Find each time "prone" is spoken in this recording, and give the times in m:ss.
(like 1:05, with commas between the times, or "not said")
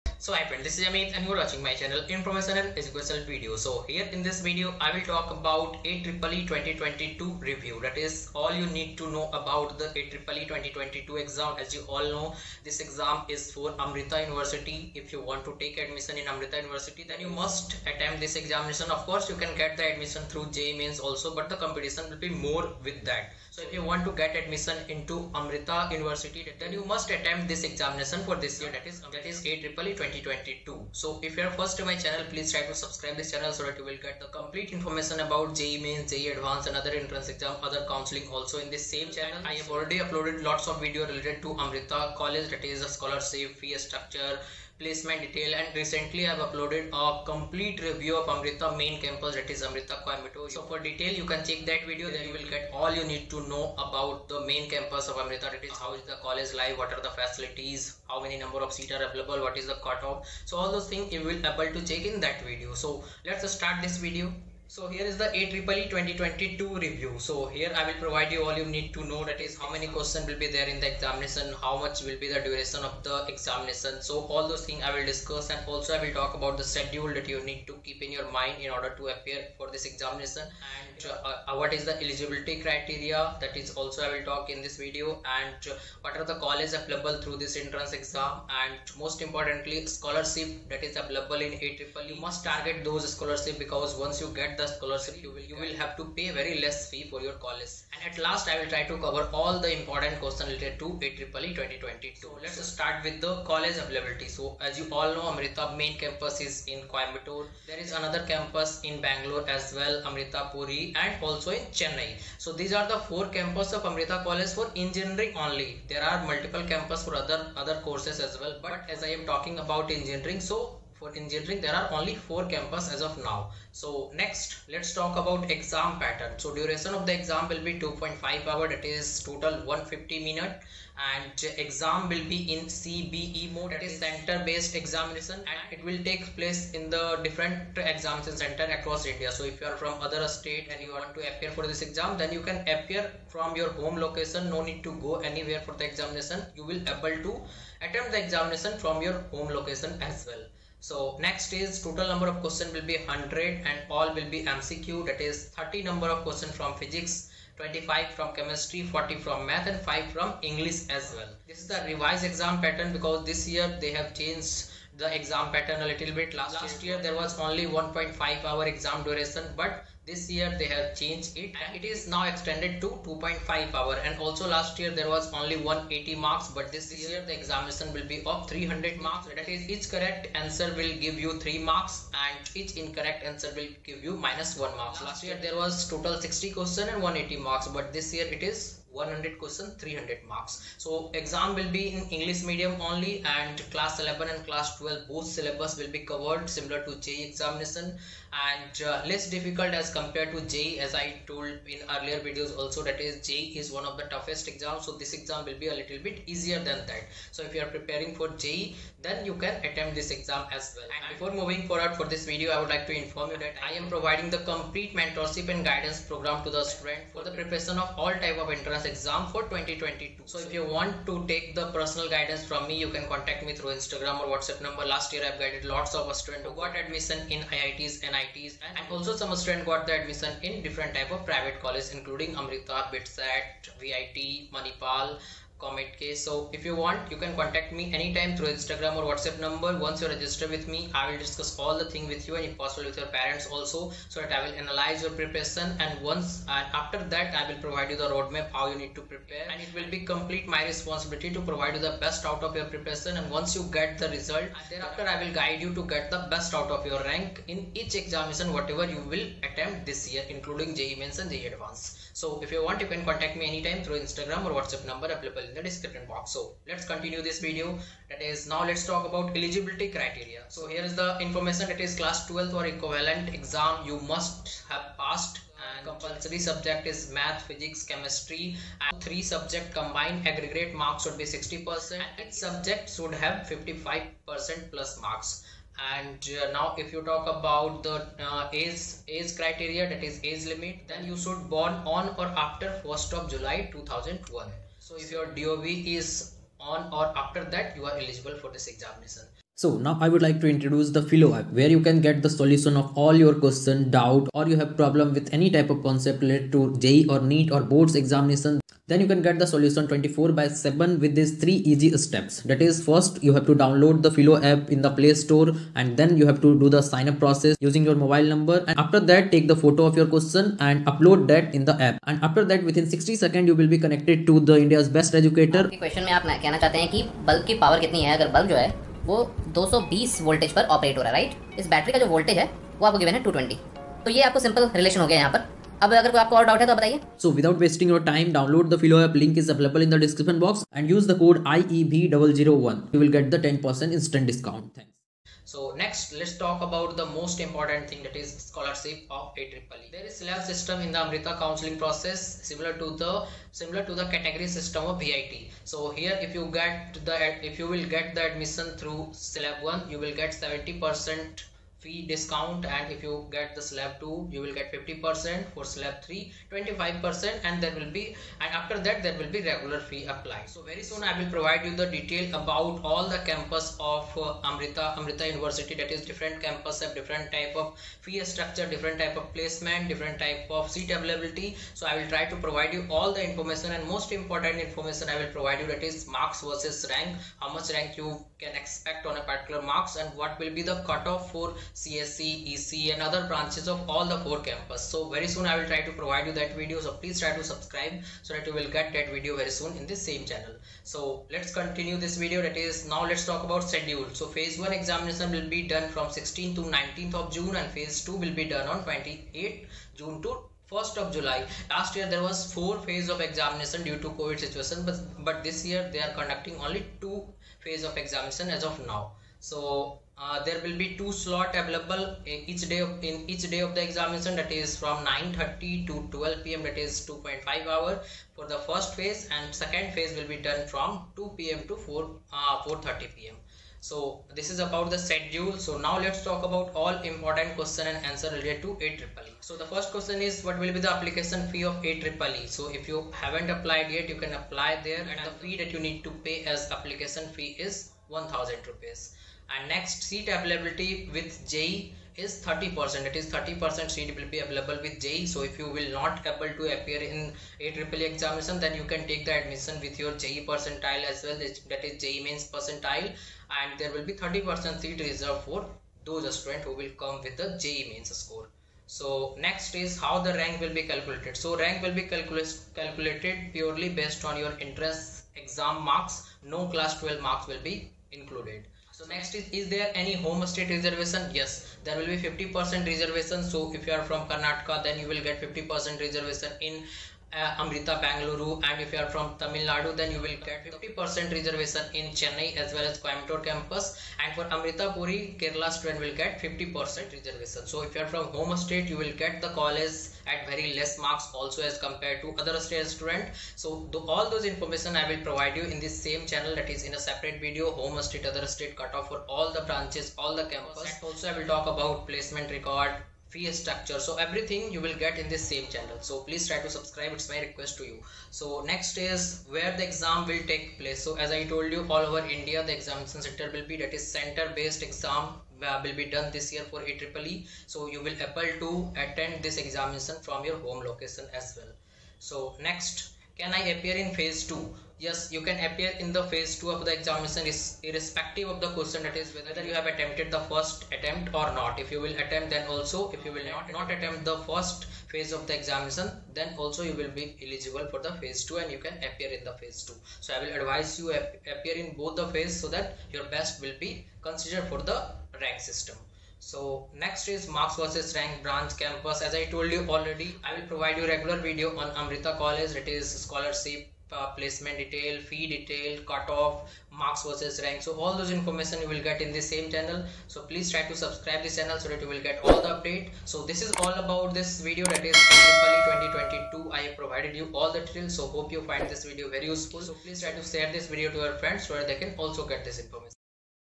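not said.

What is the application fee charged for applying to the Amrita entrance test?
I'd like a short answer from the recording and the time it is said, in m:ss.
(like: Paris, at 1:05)
1000 rupees, at 7:28.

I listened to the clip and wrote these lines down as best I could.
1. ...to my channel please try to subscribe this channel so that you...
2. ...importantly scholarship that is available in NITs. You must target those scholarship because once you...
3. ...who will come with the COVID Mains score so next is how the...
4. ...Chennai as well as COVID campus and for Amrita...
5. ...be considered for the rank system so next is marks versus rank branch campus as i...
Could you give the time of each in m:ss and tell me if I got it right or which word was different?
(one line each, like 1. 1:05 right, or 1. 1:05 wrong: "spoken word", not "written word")
1. 0:31 right
2. 1:29 wrong: "AEEE", not "NITs"
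3. 7:46 wrong: "JEE", not "COVID"
4. 8:12 wrong: "Coimbatore", not "COVID"
5. 9:13 right.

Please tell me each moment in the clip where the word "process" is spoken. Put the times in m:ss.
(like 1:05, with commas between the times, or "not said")
5:17, 5:51.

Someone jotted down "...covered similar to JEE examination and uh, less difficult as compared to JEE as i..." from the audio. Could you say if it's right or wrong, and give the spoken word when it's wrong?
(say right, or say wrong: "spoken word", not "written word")
right.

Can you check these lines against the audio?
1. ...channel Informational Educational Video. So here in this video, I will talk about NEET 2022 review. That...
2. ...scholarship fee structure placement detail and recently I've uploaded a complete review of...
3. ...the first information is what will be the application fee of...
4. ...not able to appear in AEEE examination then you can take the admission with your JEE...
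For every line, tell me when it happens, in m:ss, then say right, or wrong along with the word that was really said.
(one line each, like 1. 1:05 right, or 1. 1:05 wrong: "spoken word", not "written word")
1. 0:01 wrong: "AEEE", not "NEET"
2. 0:43 right
3. 7:19 wrong: "question", not "information"
4. 7:35 right.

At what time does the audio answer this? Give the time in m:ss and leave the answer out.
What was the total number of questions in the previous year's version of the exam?
3:06.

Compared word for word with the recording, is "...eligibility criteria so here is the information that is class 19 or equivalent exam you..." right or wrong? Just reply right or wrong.
wrong.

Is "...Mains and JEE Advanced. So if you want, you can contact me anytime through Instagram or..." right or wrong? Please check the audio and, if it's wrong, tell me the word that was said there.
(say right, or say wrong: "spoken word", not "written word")
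right.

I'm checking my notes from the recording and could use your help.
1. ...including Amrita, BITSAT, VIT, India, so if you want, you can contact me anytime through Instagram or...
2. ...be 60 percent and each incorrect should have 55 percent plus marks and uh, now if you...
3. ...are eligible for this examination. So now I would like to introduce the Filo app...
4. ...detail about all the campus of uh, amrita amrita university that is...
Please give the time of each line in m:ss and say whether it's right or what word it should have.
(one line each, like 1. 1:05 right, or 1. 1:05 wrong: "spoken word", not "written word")
1. 3:51 wrong: "Manipal", not "India"
2. 4:41 wrong: "subject", not "incorrect"
3. 4:57 right
4. 6:11 right.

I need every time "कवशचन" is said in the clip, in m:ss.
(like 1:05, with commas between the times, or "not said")
5:25.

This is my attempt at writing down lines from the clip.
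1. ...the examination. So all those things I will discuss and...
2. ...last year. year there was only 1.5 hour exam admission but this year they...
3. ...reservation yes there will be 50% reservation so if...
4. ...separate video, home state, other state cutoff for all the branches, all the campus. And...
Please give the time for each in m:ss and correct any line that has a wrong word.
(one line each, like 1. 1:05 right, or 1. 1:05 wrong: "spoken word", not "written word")
1. 1:13 right
2. 2:46 wrong: "duration", not "admission"
3. 8:00 right
4. 8:26 right.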